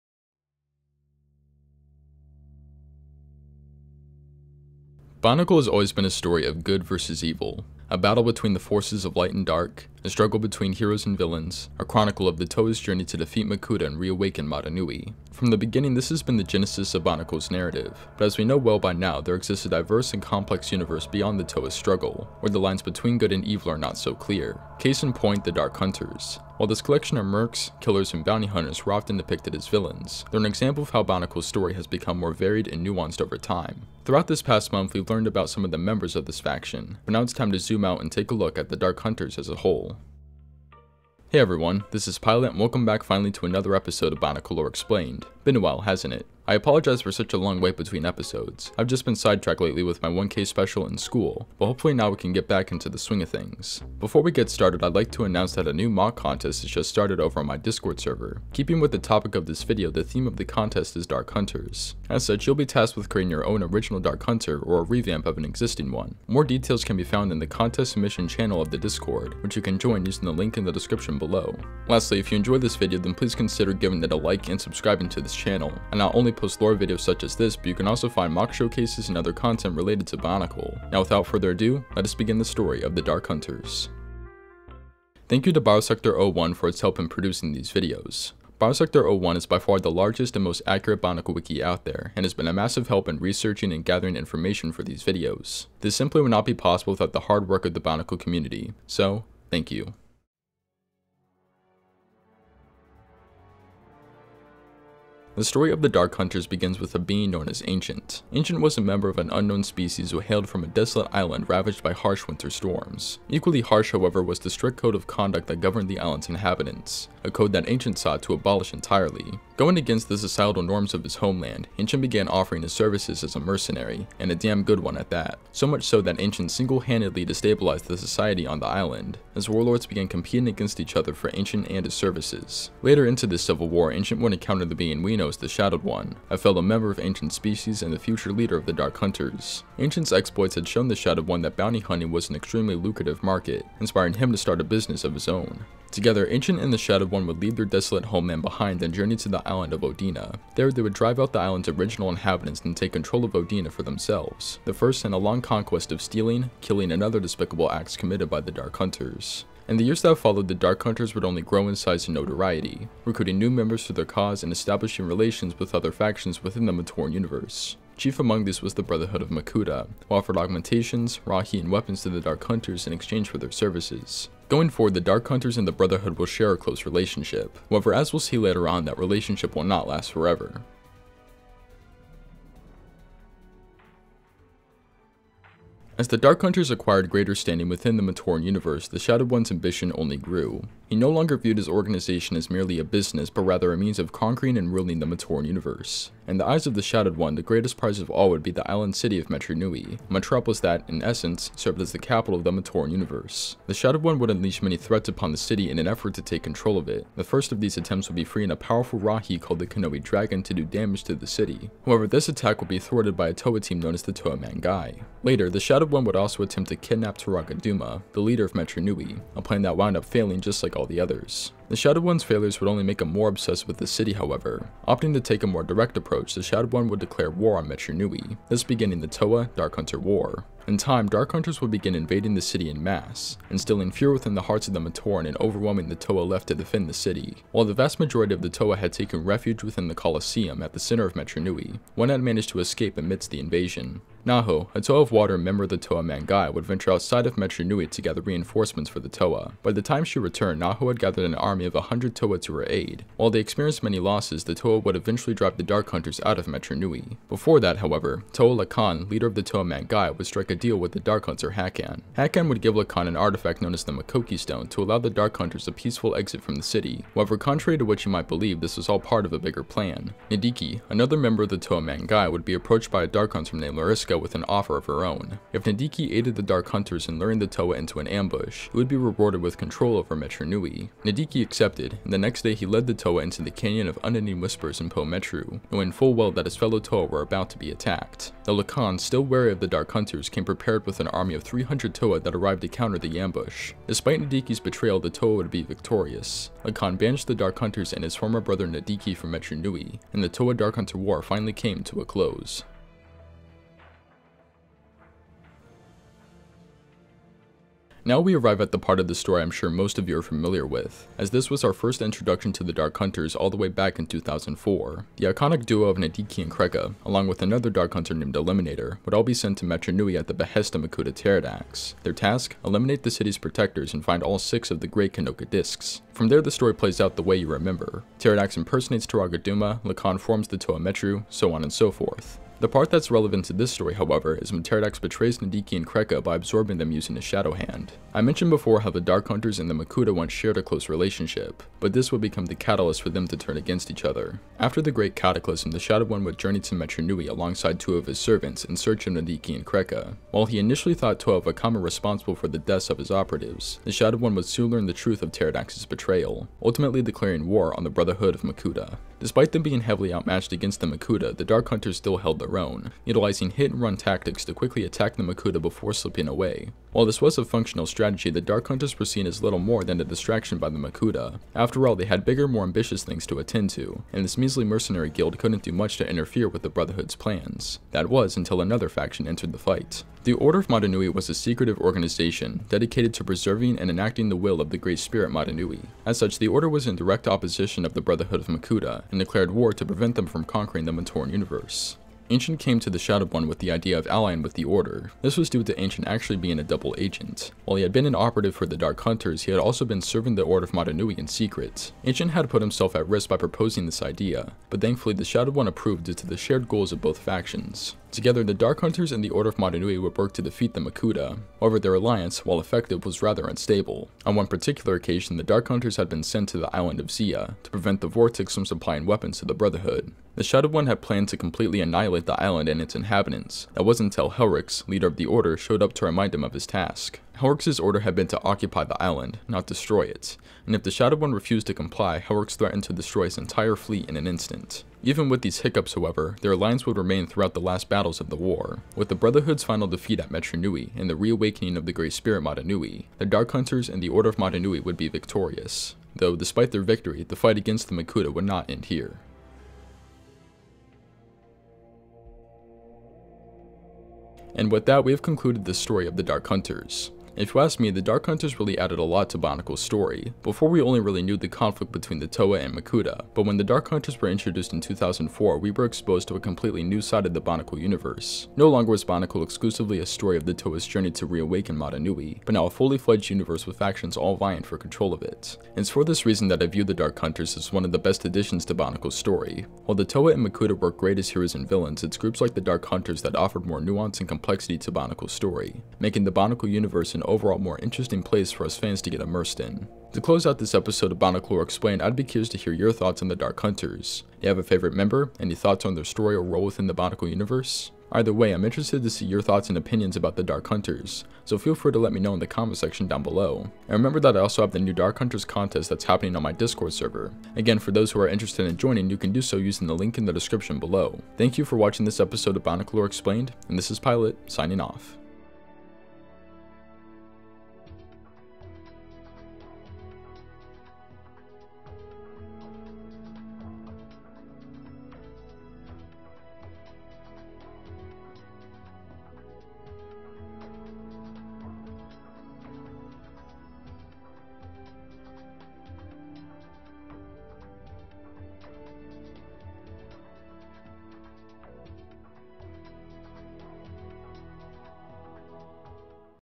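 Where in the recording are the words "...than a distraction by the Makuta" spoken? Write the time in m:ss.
6:09.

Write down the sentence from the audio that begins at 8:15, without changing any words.
Any thoughts on their story or role within the Bionicle universe?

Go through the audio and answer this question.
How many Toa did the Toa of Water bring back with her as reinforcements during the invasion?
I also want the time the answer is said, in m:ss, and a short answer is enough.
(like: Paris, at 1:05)
100, at 4:11.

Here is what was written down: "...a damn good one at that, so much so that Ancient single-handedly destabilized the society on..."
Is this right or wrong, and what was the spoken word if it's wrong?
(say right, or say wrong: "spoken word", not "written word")
right.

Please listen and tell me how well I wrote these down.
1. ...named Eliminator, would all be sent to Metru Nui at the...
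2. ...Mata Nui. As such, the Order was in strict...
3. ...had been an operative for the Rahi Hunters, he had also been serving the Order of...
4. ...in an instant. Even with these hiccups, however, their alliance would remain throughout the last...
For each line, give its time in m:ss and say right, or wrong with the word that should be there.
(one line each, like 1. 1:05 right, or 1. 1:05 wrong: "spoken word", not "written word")
1. 5:18 right
2. 6:25 wrong: "direct", not "strict"
3. 6:37 wrong: "Dark", not "Rahi"
4. 7:14 right.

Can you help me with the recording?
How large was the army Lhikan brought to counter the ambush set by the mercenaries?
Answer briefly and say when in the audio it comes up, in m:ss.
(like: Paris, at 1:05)
300 Toa, at 4:51.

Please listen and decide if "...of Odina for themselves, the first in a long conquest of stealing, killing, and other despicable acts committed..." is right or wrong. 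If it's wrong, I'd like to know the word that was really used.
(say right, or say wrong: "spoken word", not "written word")
right.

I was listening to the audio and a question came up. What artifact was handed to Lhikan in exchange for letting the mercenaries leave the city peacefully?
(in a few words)
Makoki Stone.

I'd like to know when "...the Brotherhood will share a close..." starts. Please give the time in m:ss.
2:55.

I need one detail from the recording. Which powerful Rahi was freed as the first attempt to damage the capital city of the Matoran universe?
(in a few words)
Kanohi Dragon.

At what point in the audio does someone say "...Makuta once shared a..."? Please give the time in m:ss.
5:39.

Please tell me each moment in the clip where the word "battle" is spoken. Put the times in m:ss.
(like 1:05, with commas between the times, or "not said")
0:07, 7:17.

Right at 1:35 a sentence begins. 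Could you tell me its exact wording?
This simply would not be possible without the hard work of the Bionicle community, so thank you.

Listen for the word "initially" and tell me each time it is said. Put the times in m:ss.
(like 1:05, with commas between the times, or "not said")
5:50.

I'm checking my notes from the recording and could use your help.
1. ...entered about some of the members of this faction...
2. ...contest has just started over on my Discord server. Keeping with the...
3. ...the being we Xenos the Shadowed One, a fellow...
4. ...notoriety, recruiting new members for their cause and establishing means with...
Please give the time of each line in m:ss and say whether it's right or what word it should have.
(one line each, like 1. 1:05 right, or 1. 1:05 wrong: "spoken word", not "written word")
1. 0:35 wrong: "learned", not "entered"
2. 0:56 right
3. 2:14 right
4. 2:42 wrong: "relations", not "means".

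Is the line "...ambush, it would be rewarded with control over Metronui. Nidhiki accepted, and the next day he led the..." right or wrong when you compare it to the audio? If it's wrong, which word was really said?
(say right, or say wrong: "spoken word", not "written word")
right.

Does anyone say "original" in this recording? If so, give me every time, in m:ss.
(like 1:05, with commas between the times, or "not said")
1:03, 2:31.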